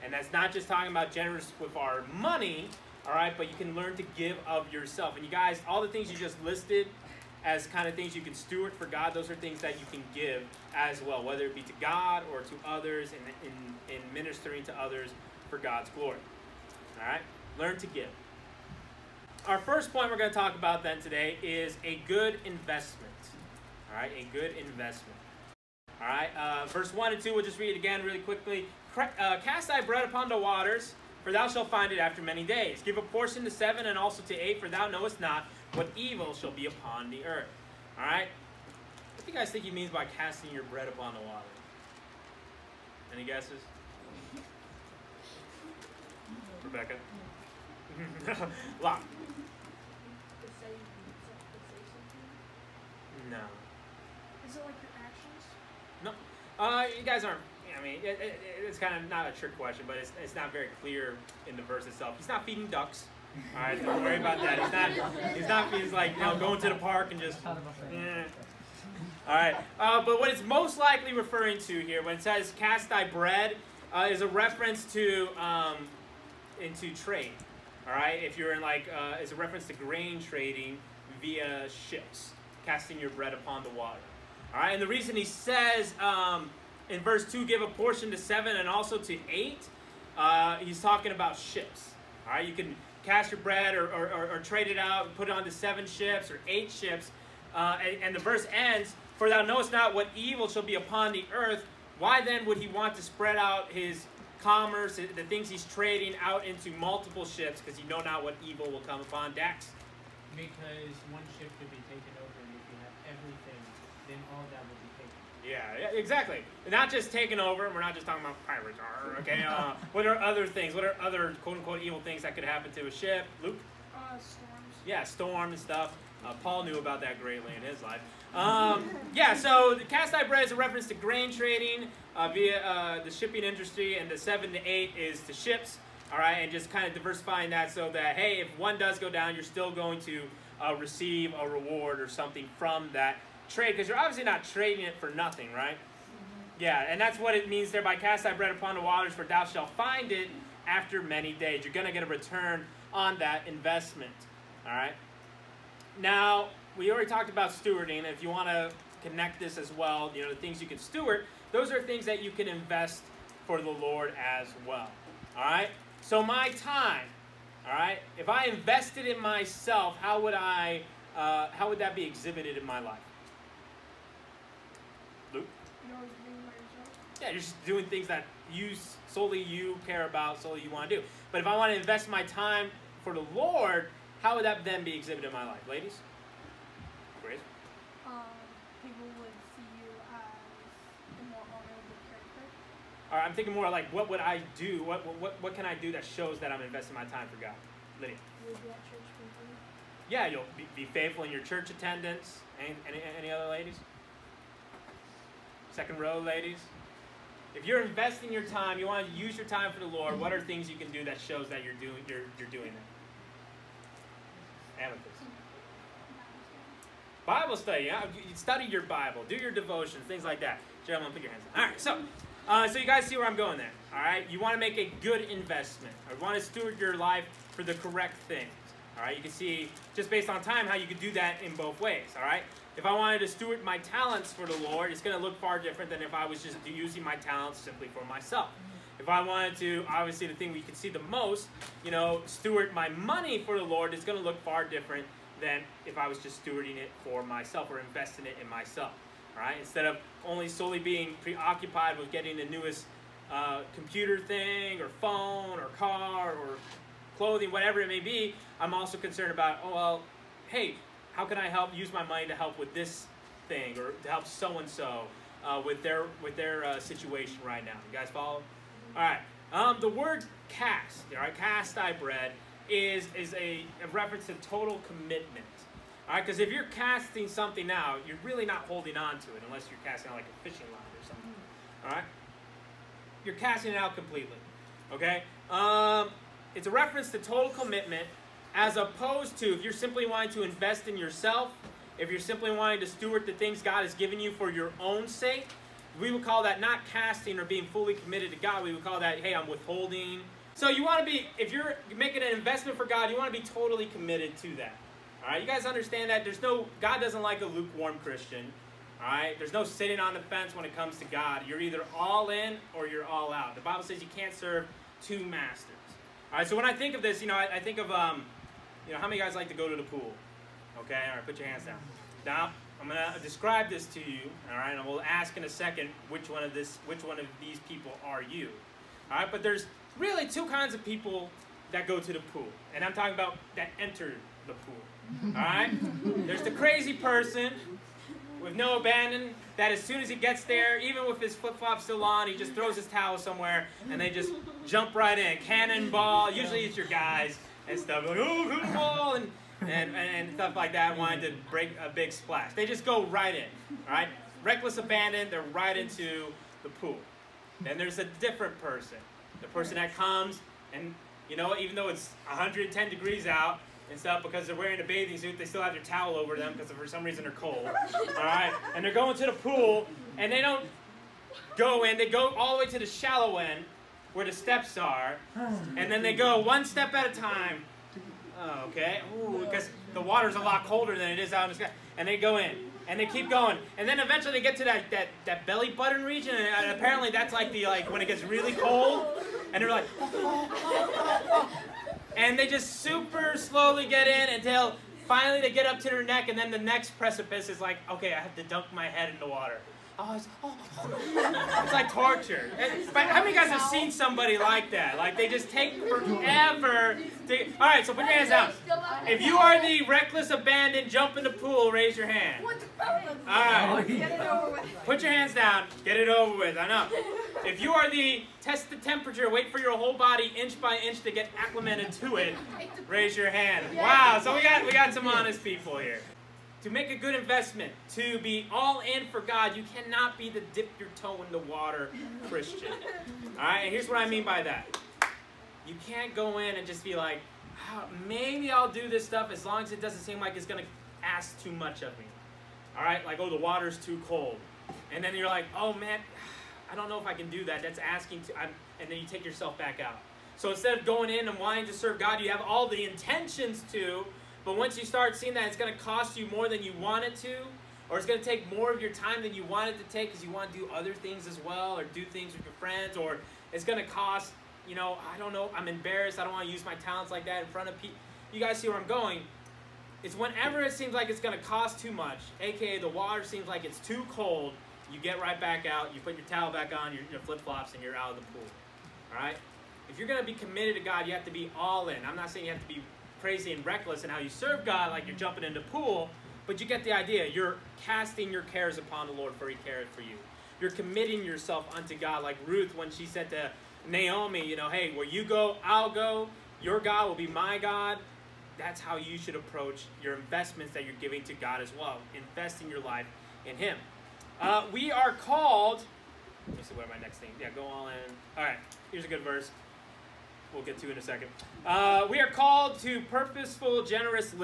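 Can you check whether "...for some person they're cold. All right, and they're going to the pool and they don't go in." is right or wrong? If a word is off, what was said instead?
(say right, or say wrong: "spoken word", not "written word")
wrong: "reason", not "person".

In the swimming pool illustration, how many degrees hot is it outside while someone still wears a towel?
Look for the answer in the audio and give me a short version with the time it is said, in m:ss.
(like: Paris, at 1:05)
110, at 6:02.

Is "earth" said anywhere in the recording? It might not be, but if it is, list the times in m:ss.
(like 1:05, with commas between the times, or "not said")
0:37, 1:41.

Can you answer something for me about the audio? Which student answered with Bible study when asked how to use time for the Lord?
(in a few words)
Amethyst.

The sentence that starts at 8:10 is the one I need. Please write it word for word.
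You're committing yourself unto God, like Ruth when she said to Naomi, you know, hey, where you go, I'll go.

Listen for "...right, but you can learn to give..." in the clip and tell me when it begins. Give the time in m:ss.
0:03.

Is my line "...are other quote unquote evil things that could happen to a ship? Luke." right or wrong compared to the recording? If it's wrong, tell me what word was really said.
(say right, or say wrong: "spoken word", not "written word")
right.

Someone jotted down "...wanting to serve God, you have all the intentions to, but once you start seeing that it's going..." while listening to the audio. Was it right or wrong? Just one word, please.
right.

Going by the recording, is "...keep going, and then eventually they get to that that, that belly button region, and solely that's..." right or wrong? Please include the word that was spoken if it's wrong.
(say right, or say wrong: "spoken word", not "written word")
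wrong: "apparently", not "solely".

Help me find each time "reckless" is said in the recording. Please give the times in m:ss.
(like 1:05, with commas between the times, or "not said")
5:54, 6:49, 8:03.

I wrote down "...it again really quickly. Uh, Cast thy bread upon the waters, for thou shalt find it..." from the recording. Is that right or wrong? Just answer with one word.
right.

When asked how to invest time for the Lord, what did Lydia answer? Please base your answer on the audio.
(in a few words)
be at church.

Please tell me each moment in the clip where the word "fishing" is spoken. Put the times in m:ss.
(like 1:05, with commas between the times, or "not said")
4:40.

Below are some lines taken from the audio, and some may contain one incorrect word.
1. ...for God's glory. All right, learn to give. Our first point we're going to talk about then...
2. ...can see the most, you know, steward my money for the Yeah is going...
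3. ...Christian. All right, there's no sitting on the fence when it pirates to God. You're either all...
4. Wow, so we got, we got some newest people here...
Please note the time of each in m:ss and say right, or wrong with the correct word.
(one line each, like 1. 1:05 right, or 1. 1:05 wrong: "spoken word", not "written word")
1. 0:15 right
2. 4:00 wrong: "Lord", not "Yeah"
3. 5:08 wrong: "comes", not "pirates"
4. 7:03 wrong: "honest", not "newest".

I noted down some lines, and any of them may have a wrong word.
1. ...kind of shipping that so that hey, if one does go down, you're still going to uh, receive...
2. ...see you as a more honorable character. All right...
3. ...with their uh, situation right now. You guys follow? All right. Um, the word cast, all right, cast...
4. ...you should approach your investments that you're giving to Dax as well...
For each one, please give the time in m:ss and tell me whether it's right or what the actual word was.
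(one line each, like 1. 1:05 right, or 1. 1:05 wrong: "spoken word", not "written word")
1. 2:16 wrong: "diversifying", not "shipping"
2. 3:09 right
3. 4:26 right
4. 8:18 wrong: "God", not "Dax".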